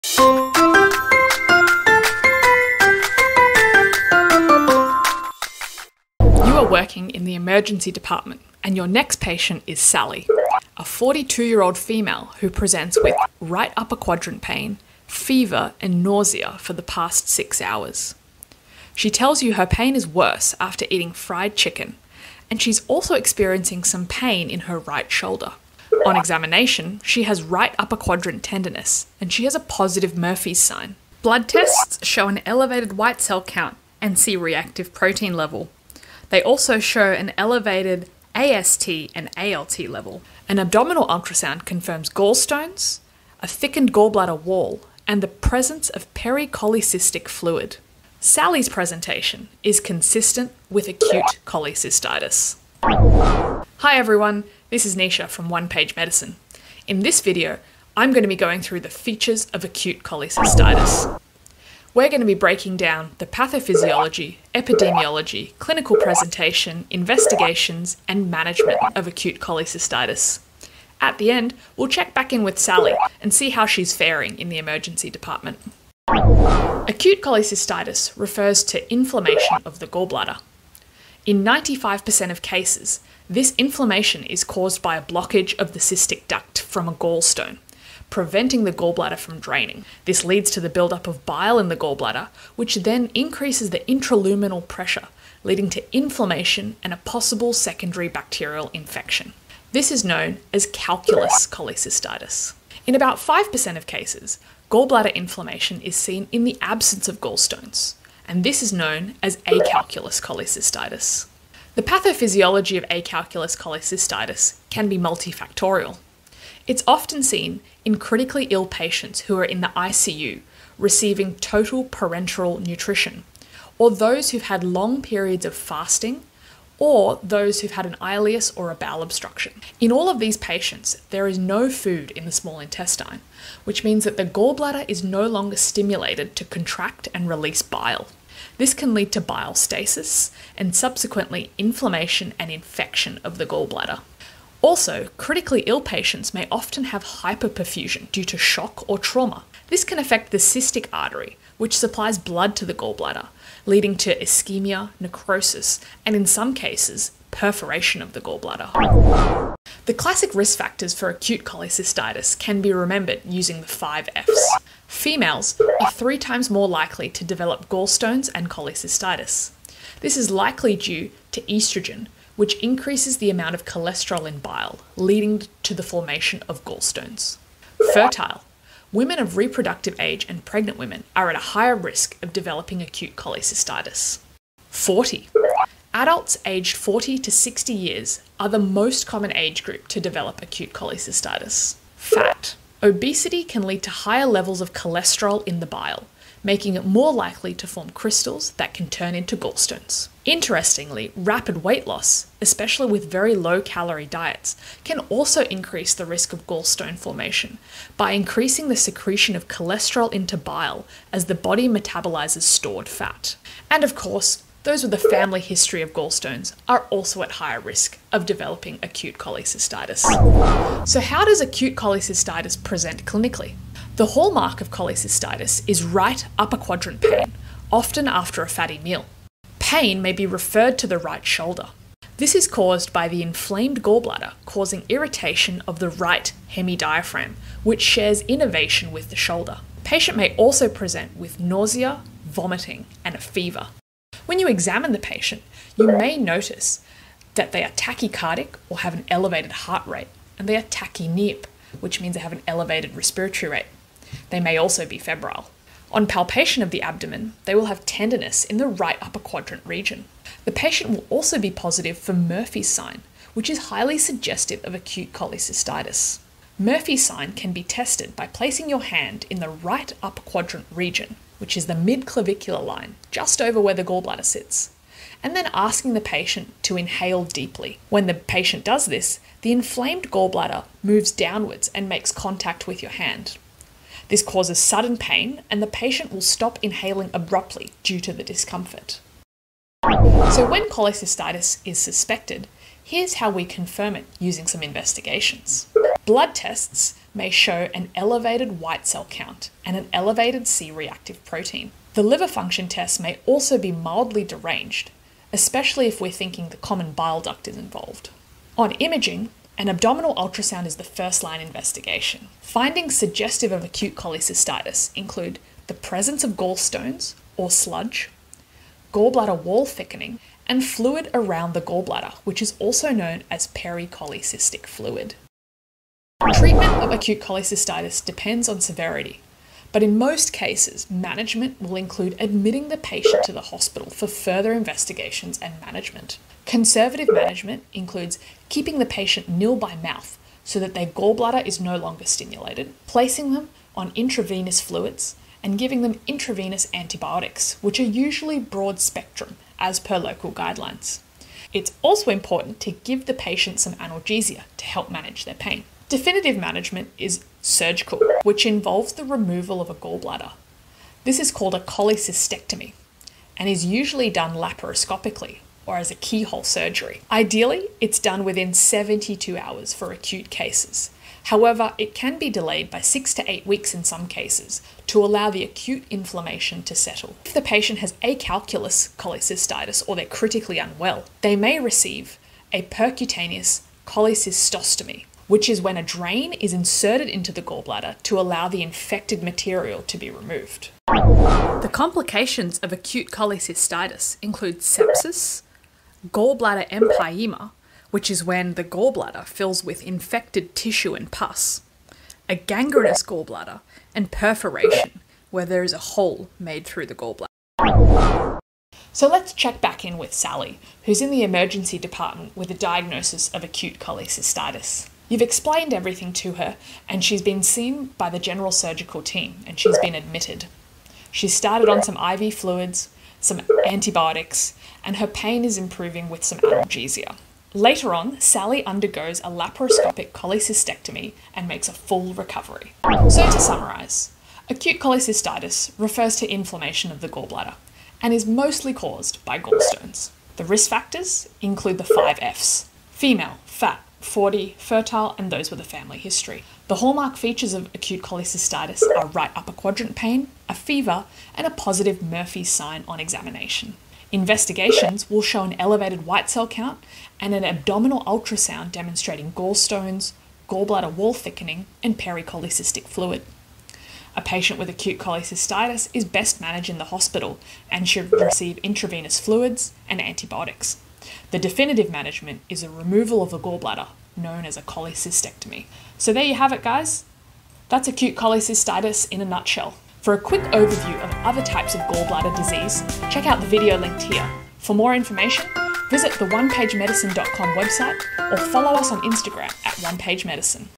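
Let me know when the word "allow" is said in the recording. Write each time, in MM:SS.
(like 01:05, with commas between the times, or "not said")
06:15, 06:28.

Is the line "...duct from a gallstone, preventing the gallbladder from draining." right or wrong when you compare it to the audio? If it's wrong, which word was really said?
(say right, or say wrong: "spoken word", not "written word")
right.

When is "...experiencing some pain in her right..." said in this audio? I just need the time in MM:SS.
00:23.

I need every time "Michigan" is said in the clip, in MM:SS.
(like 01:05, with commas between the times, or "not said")
not said.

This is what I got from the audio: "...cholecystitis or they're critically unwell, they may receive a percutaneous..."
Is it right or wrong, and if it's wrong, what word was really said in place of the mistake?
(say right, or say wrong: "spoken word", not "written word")
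right.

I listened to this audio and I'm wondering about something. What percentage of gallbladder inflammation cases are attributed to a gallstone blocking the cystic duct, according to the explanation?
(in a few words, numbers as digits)
95%.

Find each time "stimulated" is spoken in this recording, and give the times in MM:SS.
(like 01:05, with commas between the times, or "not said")
02:15, 05:42.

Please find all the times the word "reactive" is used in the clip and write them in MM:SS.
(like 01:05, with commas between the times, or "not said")
00:34, 05:00.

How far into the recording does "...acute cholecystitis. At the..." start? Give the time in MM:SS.
01:09.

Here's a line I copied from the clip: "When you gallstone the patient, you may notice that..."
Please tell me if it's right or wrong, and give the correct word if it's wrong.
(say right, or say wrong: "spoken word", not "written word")
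wrong: "examine", not "gallstone".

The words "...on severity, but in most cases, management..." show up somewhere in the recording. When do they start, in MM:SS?
05:28.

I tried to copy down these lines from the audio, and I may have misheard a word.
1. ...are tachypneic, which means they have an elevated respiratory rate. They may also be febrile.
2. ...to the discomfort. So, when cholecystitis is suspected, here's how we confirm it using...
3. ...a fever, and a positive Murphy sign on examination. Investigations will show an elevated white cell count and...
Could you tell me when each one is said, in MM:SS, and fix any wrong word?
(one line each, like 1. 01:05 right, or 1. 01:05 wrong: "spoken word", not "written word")
1. 04:10 right
2. 04:48 right
3. 07:30 right.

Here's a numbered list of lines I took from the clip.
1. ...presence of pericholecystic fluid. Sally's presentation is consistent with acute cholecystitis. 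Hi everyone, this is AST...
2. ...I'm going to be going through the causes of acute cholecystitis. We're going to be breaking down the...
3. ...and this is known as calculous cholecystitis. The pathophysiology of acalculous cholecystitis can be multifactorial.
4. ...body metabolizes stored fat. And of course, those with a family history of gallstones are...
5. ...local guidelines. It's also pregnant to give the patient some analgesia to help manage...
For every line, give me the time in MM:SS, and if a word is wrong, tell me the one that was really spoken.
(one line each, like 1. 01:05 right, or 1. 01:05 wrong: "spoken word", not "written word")
1. 00:45 wrong: "Nisha", not "AST"
2. 00:57 wrong: "features", not "causes"
3. 01:48 wrong: "acalculous", not "calculous"
4. 03:31 right
5. 05:49 wrong: "important", not "pregnant".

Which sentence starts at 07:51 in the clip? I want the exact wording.
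The definitive management is a removal of the gallbladder, known as a cholecystectomy.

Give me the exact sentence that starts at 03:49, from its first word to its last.
Pain may be referred to the right shoulder.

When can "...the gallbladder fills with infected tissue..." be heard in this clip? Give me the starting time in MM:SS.
06:38.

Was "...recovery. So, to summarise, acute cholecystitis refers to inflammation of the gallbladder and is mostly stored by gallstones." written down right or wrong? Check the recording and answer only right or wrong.
wrong.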